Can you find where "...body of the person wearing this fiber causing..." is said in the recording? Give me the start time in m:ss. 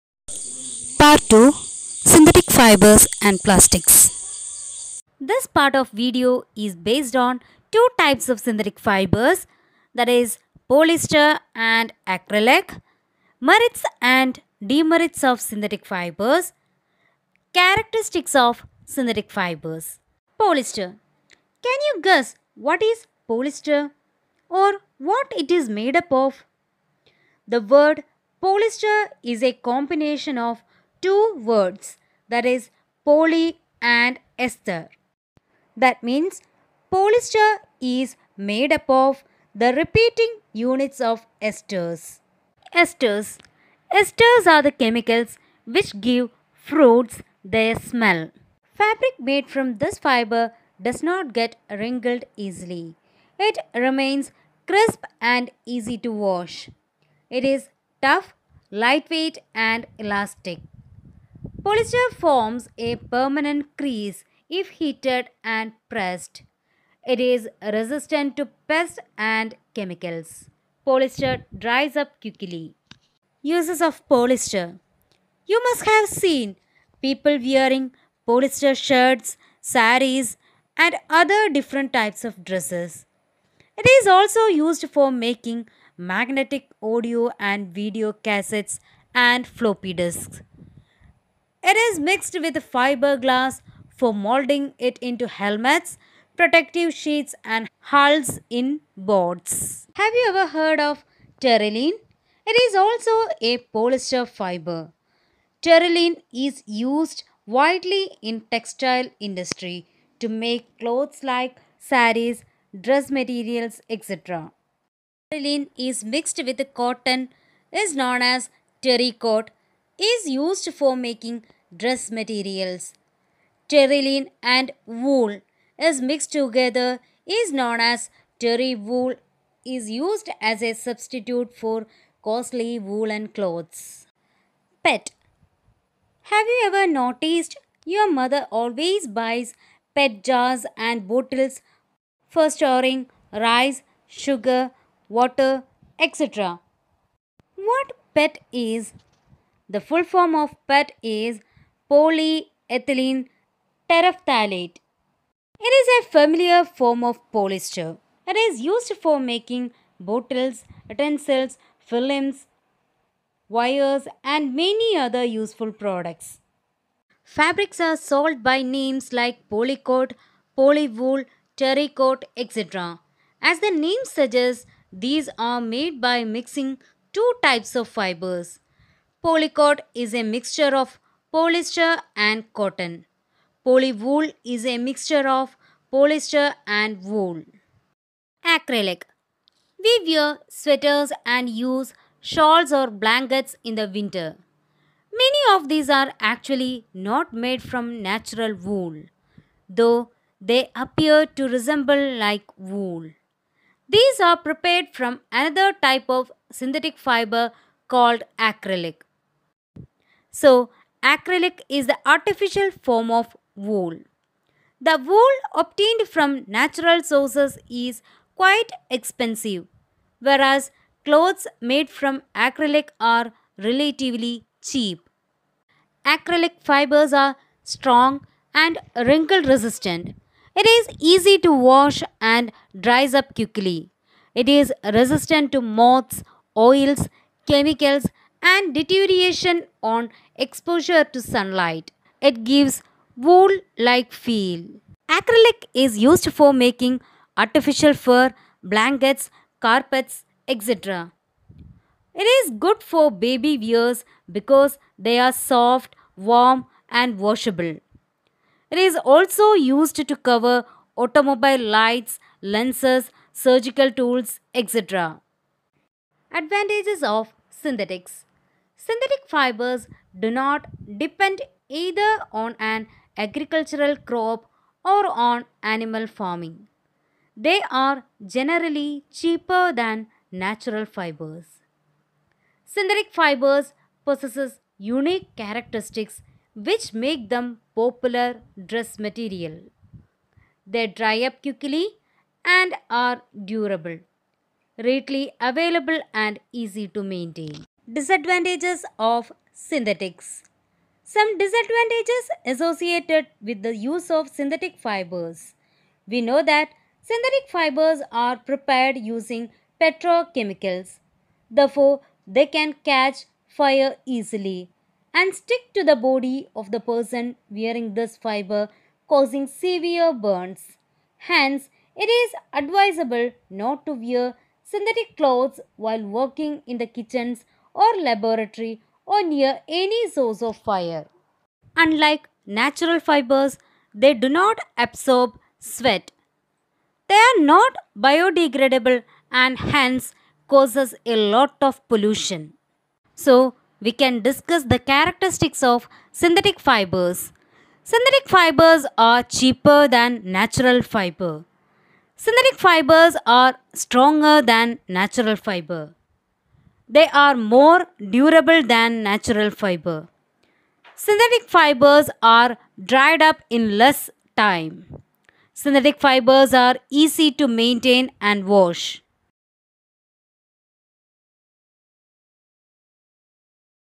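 5:15.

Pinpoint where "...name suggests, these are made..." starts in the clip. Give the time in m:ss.
2:53.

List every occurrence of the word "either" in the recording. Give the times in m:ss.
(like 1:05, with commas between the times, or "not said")
4:31.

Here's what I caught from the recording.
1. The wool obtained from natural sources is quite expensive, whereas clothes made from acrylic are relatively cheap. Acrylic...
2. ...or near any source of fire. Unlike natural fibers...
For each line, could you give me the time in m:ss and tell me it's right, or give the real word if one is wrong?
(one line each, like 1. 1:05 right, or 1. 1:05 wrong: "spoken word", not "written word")
1. 3:34 right
2. 5:29 right.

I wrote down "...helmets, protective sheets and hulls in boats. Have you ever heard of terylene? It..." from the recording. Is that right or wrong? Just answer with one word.
right.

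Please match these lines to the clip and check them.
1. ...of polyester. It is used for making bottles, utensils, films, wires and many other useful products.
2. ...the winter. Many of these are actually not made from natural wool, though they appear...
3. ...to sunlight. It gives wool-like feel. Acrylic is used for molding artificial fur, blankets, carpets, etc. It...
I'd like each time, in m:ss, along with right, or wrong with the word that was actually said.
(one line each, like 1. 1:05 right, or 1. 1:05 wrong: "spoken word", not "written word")
1. 2:37 right
2. 3:13 right
3. 4:01 wrong: "making", not "molding".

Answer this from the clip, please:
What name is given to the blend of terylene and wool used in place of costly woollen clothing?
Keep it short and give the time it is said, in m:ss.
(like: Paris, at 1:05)
Terry wool, at 2:08.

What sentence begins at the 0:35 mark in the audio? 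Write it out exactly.
That means polyester is made up of the repeating units of esters.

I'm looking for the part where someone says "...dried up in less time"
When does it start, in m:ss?
6:02.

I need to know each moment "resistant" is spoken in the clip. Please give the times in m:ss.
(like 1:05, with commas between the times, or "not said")
1:07, 3:49, 3:54.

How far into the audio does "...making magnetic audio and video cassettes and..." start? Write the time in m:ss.
1:25.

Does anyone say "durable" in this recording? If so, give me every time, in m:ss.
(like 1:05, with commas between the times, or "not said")
4:53, 5:58.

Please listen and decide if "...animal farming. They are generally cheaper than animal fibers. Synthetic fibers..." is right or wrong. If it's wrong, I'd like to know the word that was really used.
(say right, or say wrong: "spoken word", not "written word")
wrong: "natural", not "animal".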